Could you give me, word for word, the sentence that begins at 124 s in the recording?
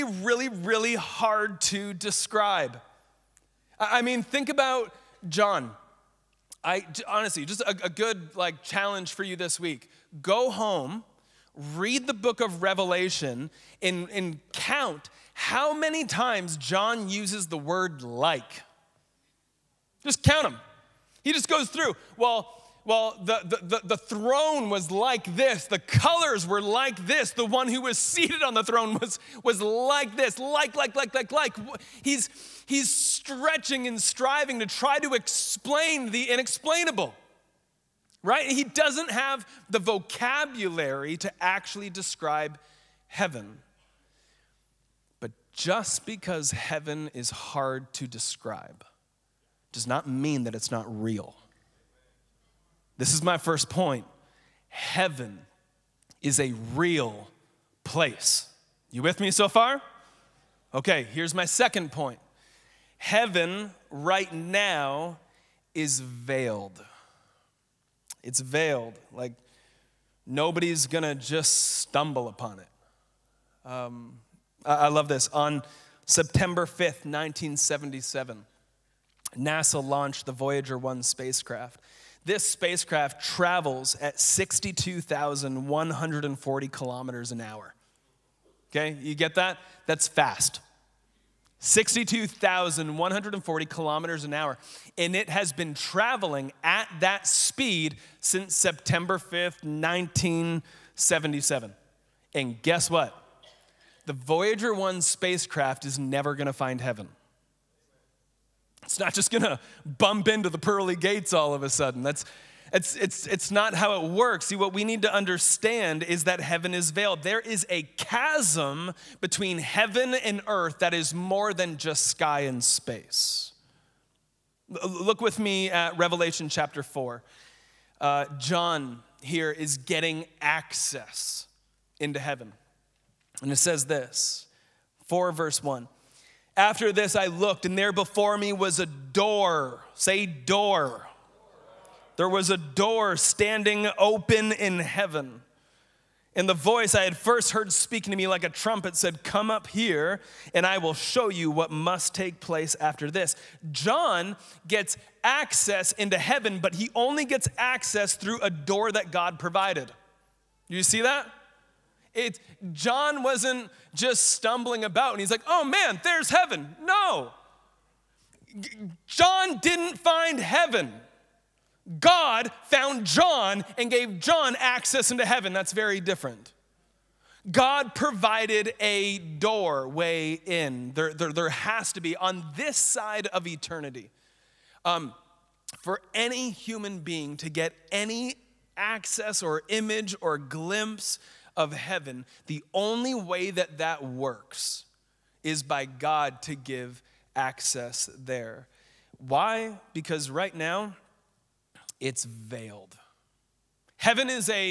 Look with me at Revelation chapter 4.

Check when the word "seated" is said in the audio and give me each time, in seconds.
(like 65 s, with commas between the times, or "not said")
27 s.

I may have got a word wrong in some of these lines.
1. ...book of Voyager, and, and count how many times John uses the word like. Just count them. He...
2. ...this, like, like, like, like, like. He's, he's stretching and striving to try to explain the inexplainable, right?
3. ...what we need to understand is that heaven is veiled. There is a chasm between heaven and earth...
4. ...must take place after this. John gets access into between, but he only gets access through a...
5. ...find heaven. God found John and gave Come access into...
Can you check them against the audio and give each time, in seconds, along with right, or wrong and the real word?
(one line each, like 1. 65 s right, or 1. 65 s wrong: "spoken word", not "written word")
1. 12 s wrong: "Revelation", not "Voyager"
2. 30 s right
3. 114 s right
4. 151 s wrong: "heaven", not "between"
5. 169 s wrong: "John", not "Come".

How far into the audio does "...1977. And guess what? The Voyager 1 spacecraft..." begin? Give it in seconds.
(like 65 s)
99 s.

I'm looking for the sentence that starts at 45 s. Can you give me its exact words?
But just because heaven is hard to describe, does not mean that it's not real.